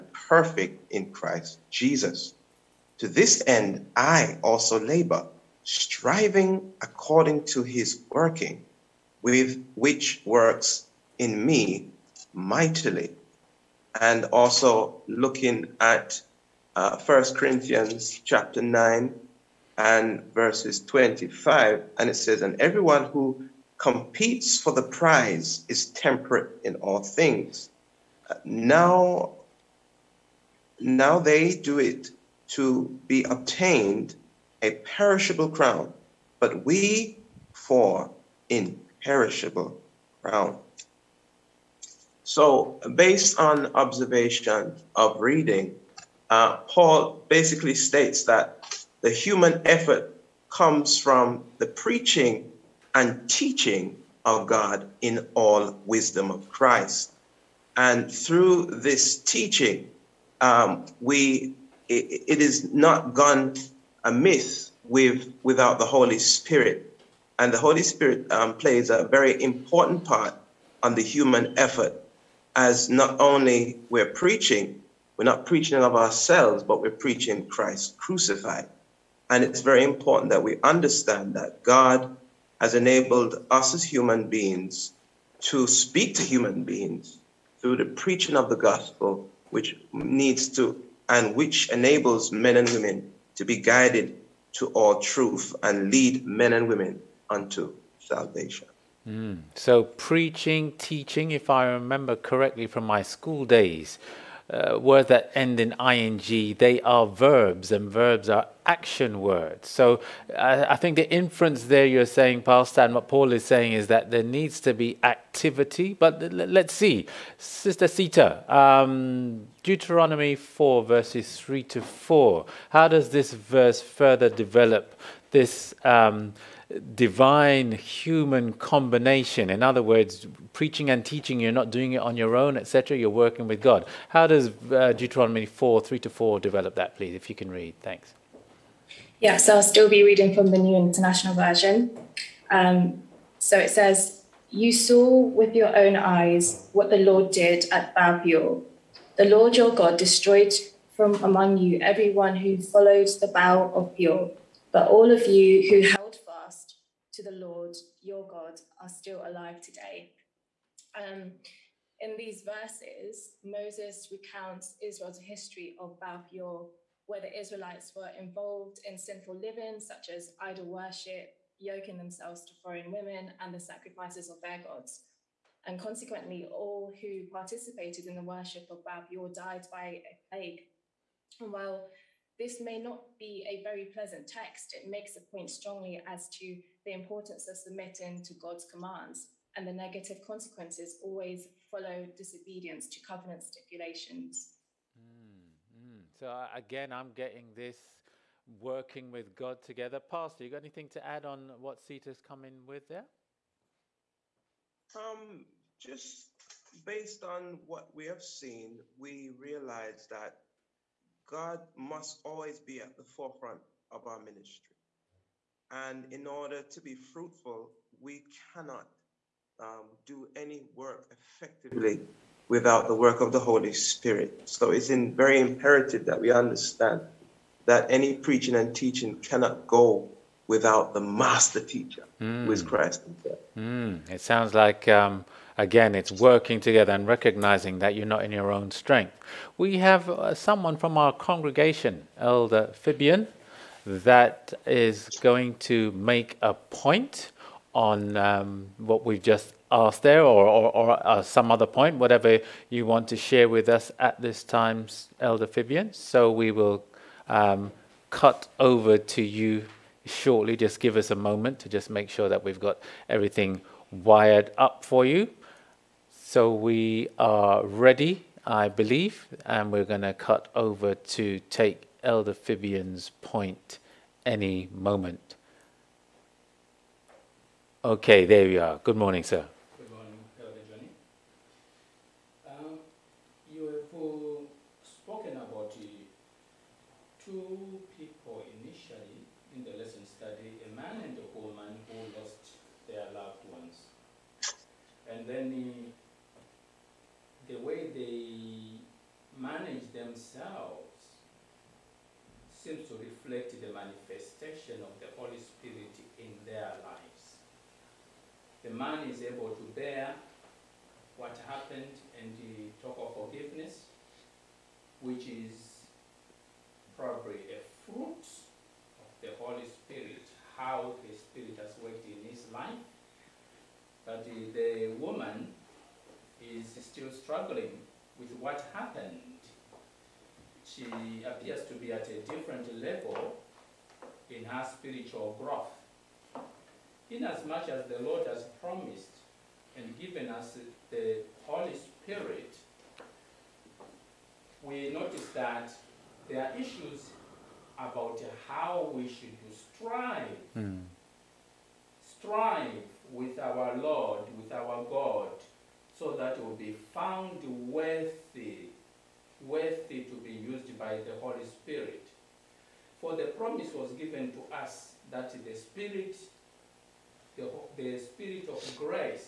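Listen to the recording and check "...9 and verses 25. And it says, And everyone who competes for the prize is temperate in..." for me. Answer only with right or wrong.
right.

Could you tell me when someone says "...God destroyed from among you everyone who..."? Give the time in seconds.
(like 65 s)
149 s.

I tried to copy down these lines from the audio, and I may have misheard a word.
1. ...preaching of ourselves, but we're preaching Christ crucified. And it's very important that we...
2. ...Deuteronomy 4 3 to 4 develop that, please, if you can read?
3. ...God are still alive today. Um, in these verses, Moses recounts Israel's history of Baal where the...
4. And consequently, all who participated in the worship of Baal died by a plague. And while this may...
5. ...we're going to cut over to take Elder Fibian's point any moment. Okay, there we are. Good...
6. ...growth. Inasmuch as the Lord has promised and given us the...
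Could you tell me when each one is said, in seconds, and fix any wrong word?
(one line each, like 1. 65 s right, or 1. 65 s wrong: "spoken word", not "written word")
1. 75 s right
2. 134 s right
3. 158 s right
4. 175 s right
5. 269 s right
6. 335 s right.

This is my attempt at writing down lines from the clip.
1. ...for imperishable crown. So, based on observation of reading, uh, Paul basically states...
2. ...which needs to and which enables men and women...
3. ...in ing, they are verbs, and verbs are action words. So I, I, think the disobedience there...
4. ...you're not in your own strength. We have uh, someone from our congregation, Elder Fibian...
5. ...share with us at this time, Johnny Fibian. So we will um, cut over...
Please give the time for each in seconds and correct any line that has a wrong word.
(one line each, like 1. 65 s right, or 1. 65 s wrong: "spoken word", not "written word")
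1. 37 s right
2. 89 s right
3. 105 s wrong: "inference", not "disobedience"
4. 237 s right
5. 253 s wrong: "Elder", not "Johnny".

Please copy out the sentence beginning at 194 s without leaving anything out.
Mm, So, uh, again, I'm getting this working with God together.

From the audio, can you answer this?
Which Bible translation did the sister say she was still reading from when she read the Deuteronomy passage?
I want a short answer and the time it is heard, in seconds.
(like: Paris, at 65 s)
New International Version, at 140 s.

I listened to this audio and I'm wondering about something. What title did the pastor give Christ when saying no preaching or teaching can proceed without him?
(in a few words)
the master teacher.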